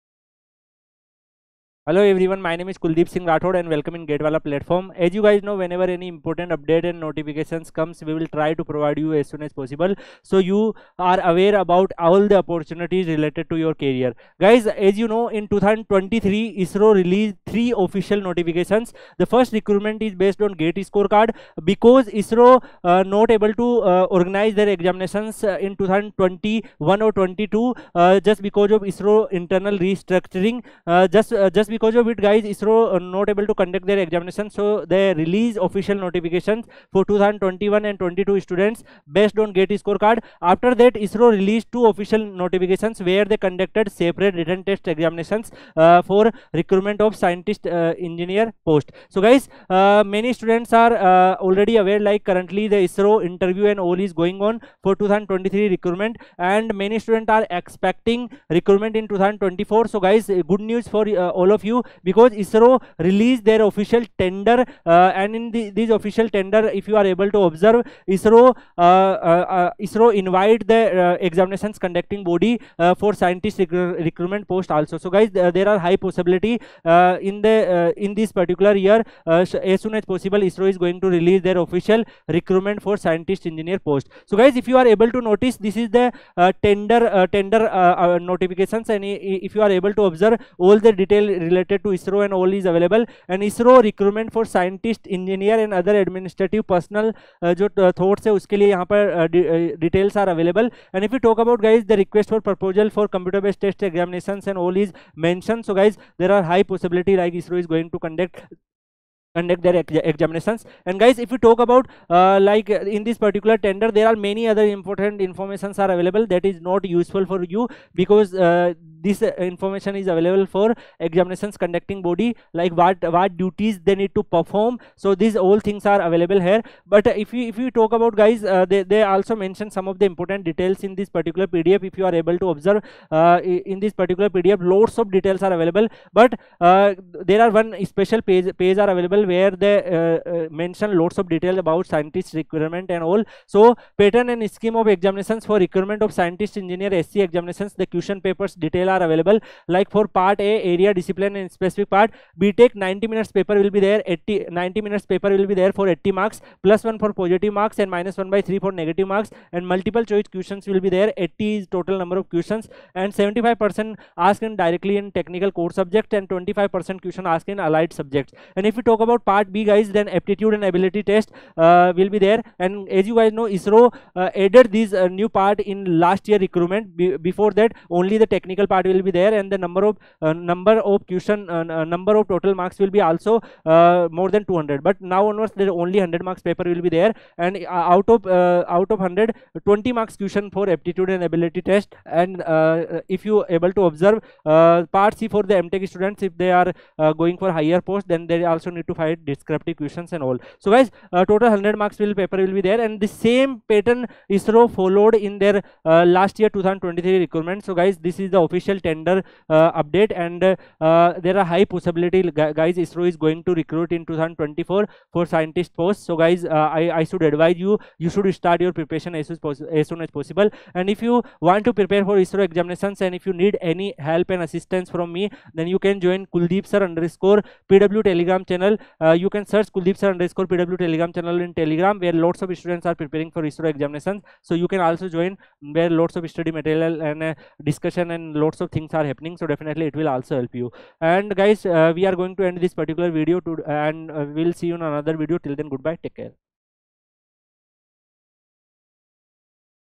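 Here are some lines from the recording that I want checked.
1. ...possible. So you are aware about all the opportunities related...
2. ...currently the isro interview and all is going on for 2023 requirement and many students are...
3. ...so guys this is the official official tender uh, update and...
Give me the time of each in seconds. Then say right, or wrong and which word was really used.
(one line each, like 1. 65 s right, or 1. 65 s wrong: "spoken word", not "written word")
1. 9 s right
2. 52 s wrong: "recruitment", not "requirement"
3. 207 s right.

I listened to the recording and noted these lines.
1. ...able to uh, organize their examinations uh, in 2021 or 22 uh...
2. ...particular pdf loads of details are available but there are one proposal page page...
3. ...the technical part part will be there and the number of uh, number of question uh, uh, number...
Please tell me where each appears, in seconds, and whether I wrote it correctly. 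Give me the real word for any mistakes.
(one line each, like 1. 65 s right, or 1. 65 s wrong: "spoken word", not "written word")
1. 23 s right
2. 133 s wrong: "special", not "proposal"
3. 178 s right.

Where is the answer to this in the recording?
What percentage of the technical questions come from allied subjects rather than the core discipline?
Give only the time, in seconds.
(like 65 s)
166 s.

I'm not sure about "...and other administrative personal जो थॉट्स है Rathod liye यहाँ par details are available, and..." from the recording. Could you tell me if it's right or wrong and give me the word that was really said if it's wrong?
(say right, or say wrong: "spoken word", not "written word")
wrong: "Uske", not "Rathod".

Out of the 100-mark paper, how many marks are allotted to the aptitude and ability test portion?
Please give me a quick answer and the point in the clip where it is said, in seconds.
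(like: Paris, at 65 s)
20 marks, at 189 s.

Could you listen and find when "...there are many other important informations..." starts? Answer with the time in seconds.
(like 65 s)
113 s.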